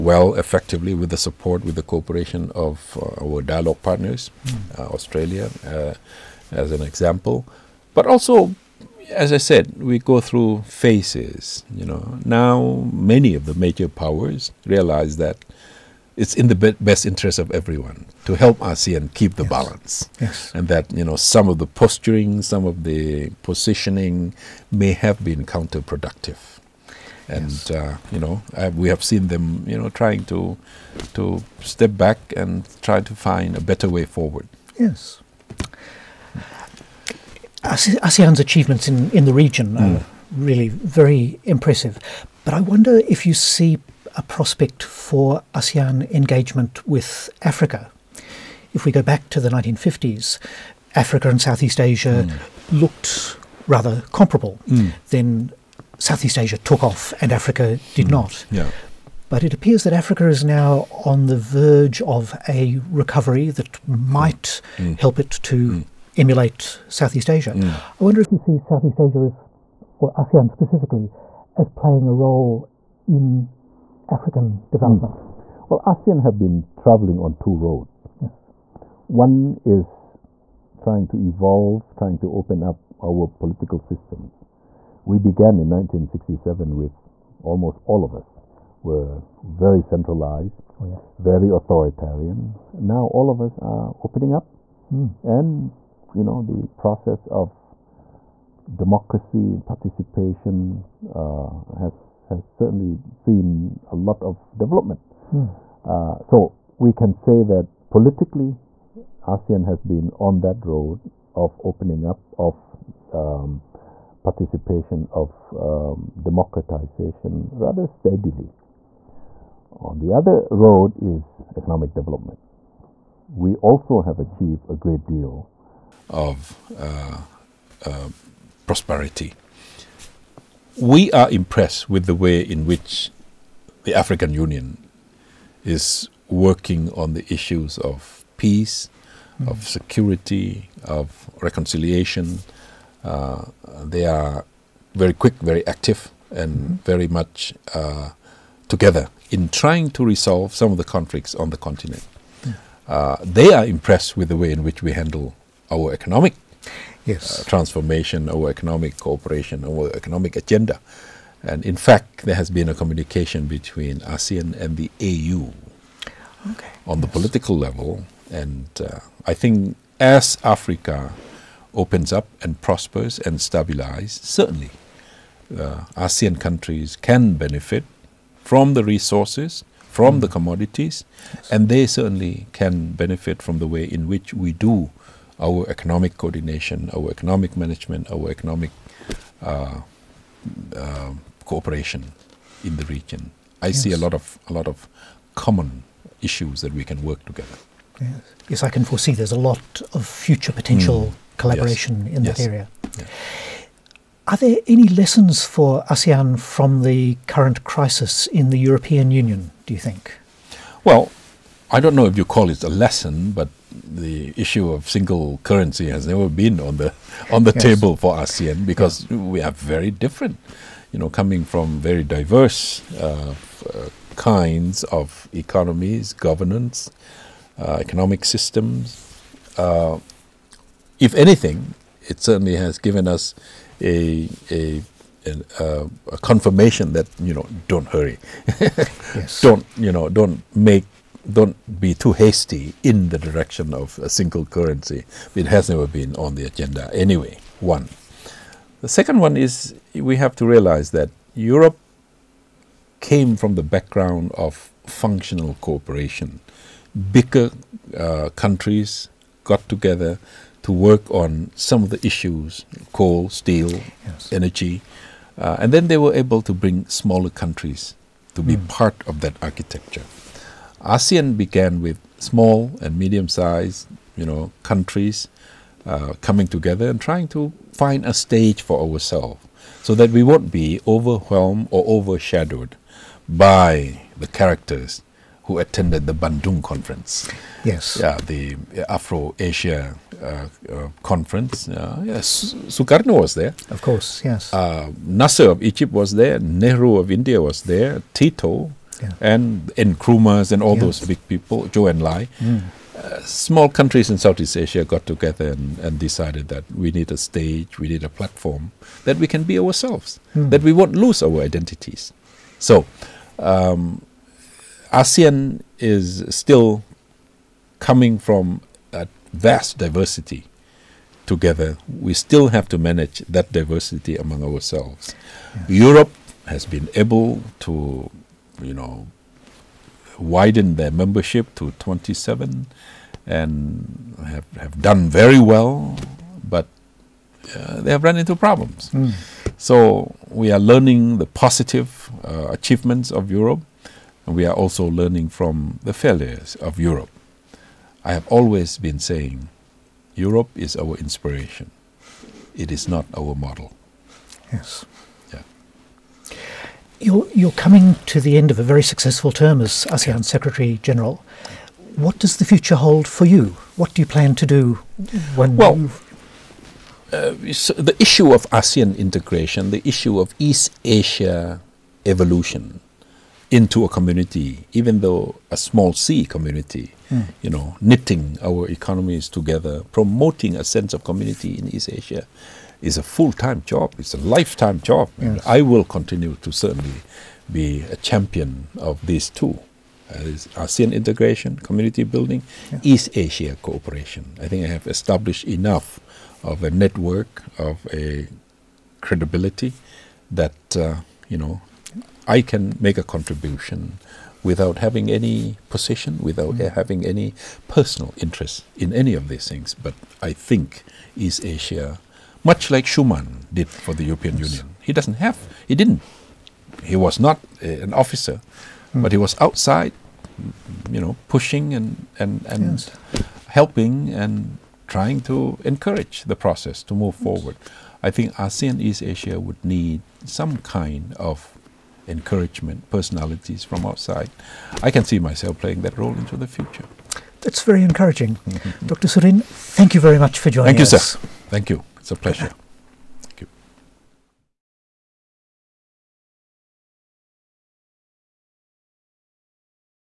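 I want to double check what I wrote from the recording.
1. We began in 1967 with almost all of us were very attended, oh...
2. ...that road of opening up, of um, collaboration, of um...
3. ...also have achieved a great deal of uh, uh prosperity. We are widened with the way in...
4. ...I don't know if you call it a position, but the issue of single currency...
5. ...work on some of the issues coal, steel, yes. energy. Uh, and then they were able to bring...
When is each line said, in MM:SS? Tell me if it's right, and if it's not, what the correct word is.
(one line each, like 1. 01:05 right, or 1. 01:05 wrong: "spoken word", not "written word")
1. 01:25 wrong: "centralized", not "attended"
2. 01:50 wrong: "participation", not "collaboration"
3. 02:03 wrong: "impressed", not "widened"
4. 03:31 wrong: "lesson", not "position"
5. 04:20 right.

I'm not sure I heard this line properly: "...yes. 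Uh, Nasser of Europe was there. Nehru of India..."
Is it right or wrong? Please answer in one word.
wrong.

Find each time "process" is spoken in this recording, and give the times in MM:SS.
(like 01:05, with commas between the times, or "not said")
01:36, 07:06.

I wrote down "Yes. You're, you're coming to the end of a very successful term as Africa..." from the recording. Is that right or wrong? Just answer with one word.
wrong.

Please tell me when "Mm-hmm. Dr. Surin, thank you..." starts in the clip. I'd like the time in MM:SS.
07:18.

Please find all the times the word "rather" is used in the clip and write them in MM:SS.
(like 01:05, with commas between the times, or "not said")
00:53, 01:57.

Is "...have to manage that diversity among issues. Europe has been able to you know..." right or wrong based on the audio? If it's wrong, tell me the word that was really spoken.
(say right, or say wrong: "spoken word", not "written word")
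wrong: "ourselves", not "issues".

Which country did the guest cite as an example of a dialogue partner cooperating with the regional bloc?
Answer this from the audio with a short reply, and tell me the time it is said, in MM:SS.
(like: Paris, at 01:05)
Australia, at 00:04.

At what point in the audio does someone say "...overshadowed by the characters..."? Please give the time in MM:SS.
04:41.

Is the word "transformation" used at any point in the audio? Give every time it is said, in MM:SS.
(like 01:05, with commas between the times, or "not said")
02:37.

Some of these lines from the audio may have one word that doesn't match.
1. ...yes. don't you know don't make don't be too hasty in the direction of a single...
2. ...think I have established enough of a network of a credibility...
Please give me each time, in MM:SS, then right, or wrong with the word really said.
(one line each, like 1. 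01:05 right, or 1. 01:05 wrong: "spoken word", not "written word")
1. 03:58 right
2. 06:34 right.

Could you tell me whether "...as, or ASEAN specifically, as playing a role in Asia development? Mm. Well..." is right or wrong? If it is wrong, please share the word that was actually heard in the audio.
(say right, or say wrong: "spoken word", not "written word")
wrong: "African", not "Asia".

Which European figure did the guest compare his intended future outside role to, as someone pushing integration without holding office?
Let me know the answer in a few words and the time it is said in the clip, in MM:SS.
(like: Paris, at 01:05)
Schuman, at 06:52.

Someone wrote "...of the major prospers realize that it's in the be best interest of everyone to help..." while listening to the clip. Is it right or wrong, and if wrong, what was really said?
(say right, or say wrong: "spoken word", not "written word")
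wrong: "powers", not "prospers".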